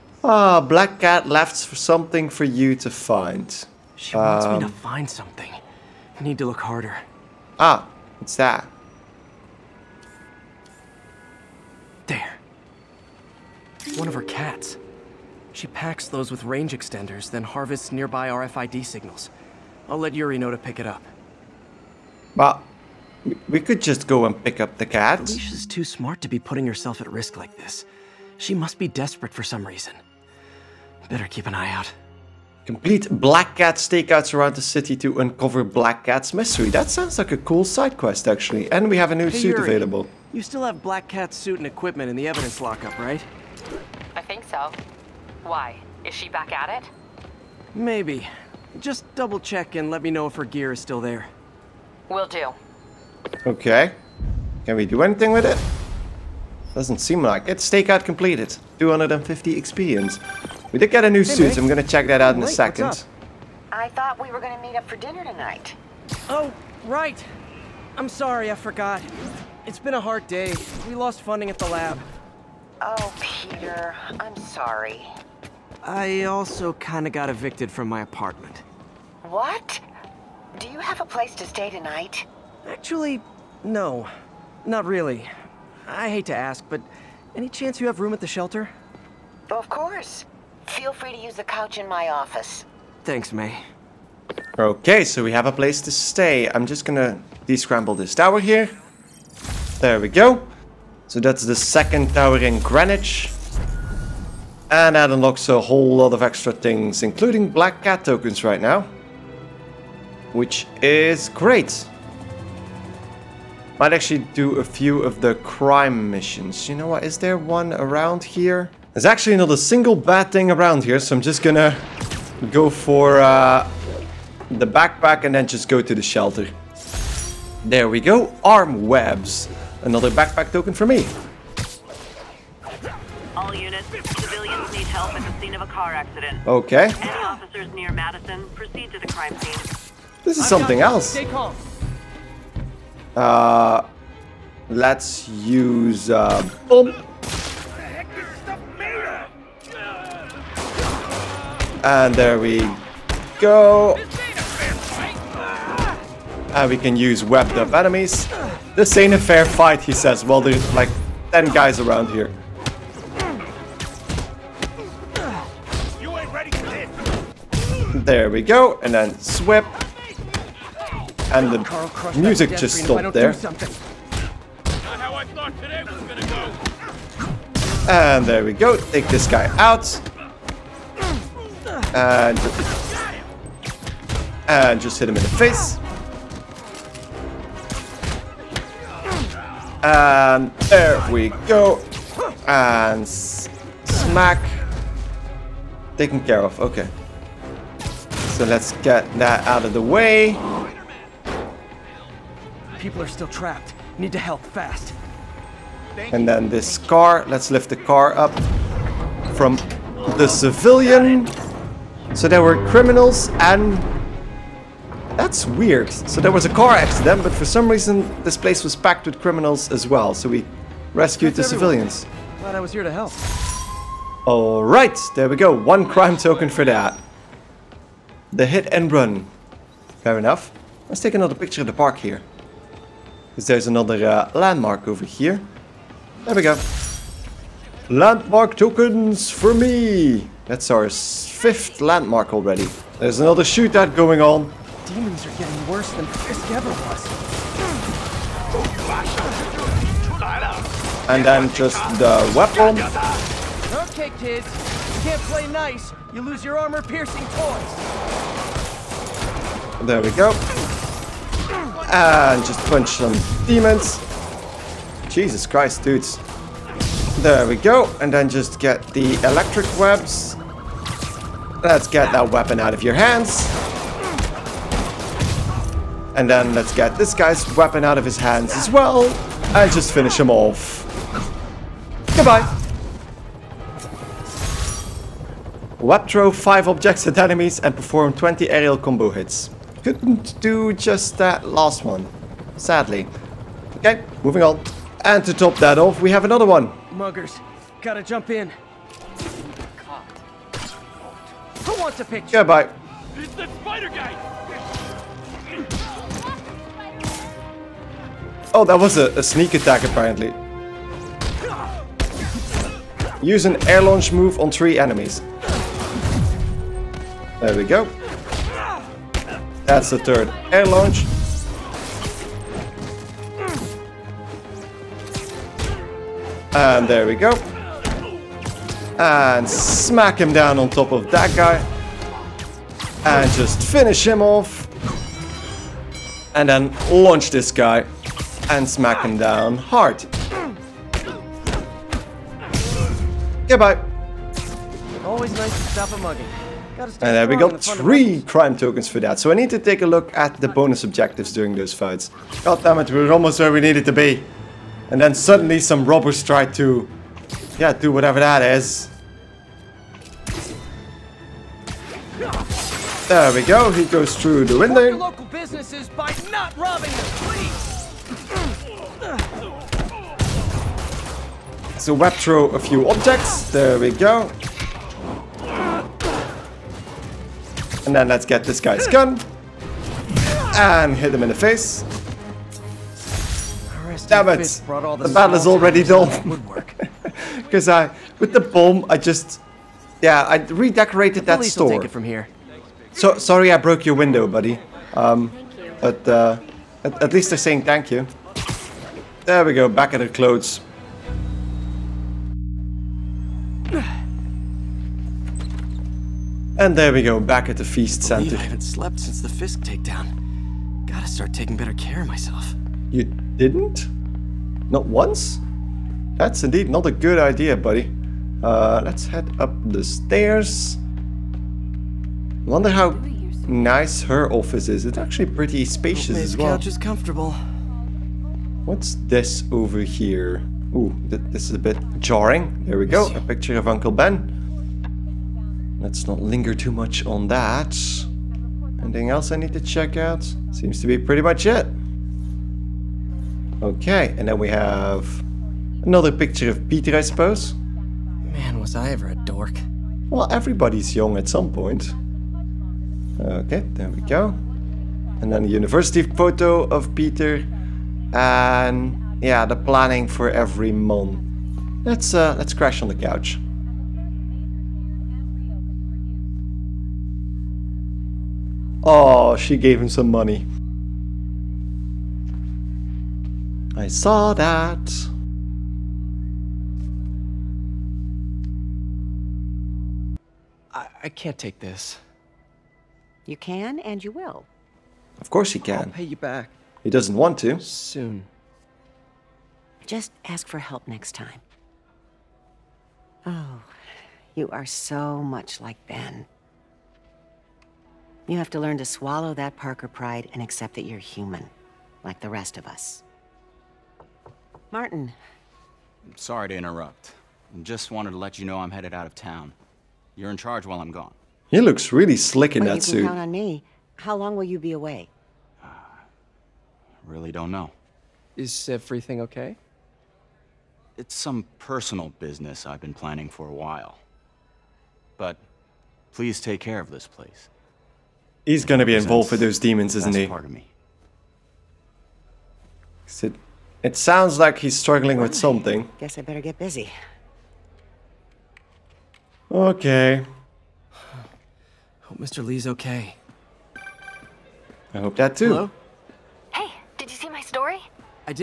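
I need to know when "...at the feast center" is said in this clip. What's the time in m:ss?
6:47.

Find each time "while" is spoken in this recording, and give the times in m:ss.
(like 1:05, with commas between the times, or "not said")
8:30, 8:43.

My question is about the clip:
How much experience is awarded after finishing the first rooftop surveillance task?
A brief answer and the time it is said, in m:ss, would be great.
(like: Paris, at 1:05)
250, at 0:58.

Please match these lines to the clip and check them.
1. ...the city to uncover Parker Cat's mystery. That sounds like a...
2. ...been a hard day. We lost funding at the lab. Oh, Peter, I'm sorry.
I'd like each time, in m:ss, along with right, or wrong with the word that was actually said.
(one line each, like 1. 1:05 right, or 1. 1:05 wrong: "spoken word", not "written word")
1. 0:34 wrong: "Black", not "Parker"
2. 1:09 right.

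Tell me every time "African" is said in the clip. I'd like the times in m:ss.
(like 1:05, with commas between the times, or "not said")
not said.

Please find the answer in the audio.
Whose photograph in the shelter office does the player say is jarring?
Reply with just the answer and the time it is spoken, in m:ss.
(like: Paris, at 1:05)
Uncle Ben, at 7:13.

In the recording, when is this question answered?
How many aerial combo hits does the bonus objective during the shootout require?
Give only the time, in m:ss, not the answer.
4:48.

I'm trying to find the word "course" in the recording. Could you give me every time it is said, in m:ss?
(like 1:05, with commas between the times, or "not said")
1:29, 8:05.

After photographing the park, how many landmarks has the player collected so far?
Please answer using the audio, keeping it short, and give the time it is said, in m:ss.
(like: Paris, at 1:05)
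5, at 4:00.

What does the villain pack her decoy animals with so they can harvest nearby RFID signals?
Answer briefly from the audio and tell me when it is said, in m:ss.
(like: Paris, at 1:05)
Range extenders, at 0:16.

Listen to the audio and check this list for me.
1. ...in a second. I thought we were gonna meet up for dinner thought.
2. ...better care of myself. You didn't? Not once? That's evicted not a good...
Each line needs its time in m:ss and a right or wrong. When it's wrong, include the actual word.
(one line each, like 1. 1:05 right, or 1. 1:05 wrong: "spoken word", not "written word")
1. 1:02 wrong: "tonight", not "thought"
2. 6:51 wrong: "indeed", not "evicted".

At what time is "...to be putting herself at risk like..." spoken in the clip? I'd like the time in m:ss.
0:26.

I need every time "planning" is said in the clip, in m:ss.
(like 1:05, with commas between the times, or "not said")
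7:39, 8:42.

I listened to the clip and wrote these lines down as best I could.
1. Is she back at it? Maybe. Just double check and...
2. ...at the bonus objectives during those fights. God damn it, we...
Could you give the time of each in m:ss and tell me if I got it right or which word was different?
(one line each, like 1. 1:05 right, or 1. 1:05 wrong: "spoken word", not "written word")
1. 0:46 right
2. 5:50 right.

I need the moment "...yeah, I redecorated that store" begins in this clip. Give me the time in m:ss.
6:30.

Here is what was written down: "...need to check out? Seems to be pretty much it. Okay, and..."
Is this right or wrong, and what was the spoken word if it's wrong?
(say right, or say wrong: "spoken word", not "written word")
right.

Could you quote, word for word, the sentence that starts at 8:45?
But please take care of this place.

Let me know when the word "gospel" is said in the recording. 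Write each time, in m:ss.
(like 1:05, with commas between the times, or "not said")
not said.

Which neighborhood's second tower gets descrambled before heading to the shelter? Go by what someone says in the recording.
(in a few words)
Greenwich.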